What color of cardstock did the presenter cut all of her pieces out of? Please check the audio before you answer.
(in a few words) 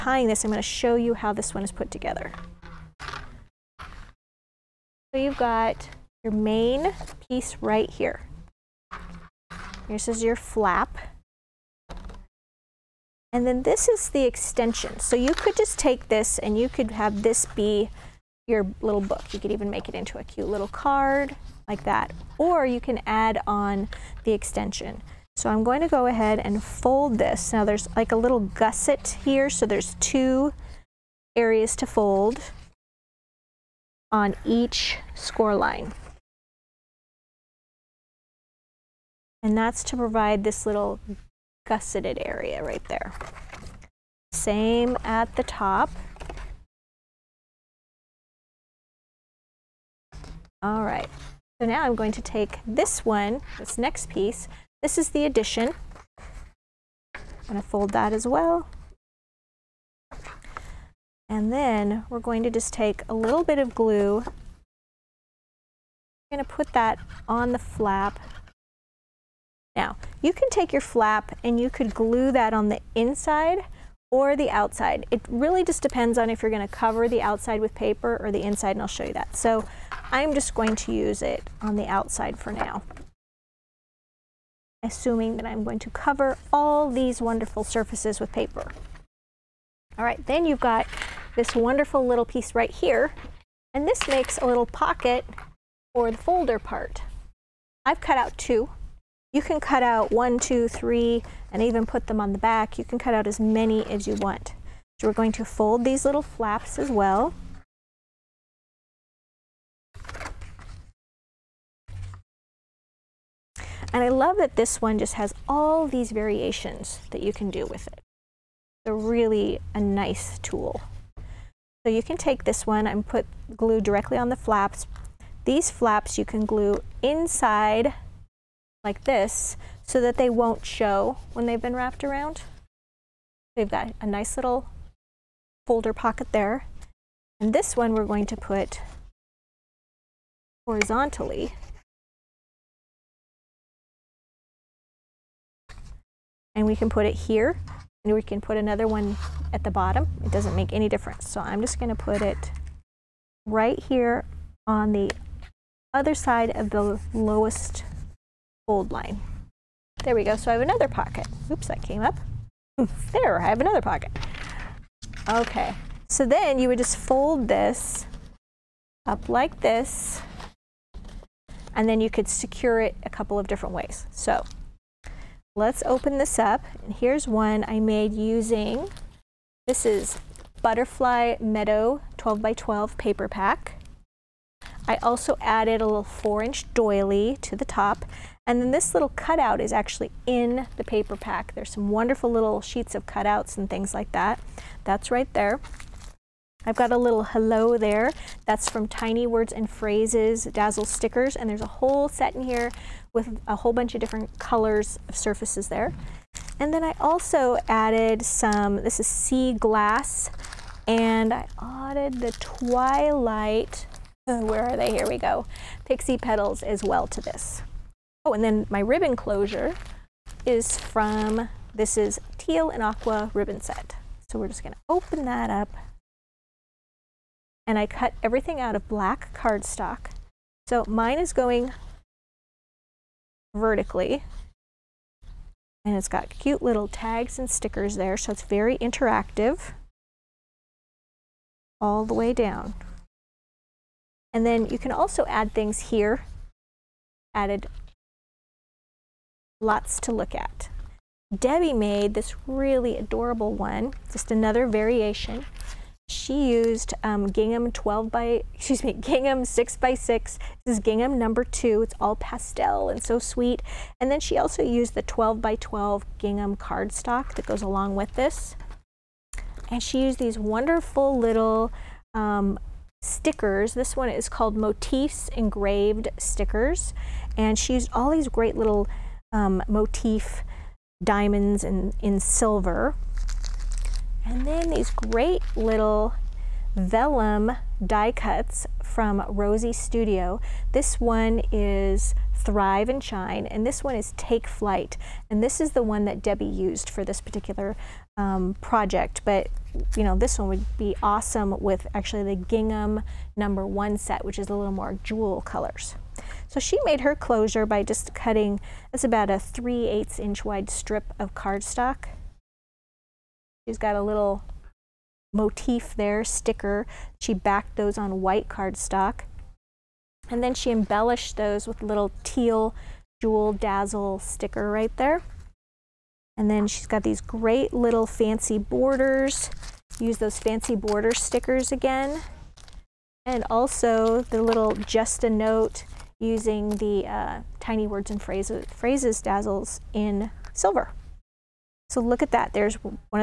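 Black.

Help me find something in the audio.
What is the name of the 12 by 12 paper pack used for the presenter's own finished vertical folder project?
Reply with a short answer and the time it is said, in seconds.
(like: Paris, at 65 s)
Butterfly Meadow, at 180 s.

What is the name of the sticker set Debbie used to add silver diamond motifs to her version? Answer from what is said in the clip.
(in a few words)
Motifs Engraved Stickers.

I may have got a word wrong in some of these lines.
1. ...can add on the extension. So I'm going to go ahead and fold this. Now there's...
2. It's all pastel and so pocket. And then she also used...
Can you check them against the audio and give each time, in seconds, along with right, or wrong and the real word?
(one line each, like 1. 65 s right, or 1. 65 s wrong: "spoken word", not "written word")
1. 22 s right
2. 261 s wrong: "sweet", not "pocket".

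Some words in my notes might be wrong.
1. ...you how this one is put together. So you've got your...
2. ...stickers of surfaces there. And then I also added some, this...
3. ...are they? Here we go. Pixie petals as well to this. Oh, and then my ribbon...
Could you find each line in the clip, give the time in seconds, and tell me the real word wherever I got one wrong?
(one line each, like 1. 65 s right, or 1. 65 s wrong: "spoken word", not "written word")
1. 0 s right
2. 204 s wrong: "colors", not "stickers"
3. 214 s right.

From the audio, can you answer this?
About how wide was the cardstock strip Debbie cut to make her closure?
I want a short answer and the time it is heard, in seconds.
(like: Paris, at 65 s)
3/8 inch, at 309 s.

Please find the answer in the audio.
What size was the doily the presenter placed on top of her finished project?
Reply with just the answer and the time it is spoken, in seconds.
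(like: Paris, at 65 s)
4 inch, at 186 s.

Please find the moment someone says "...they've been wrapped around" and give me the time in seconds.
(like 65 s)
131 s.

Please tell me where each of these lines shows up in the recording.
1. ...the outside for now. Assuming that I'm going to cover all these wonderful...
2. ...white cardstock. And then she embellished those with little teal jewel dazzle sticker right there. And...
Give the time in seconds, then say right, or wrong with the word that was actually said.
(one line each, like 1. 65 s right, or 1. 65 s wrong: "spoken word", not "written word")
1. 81 s right
2. 318 s right.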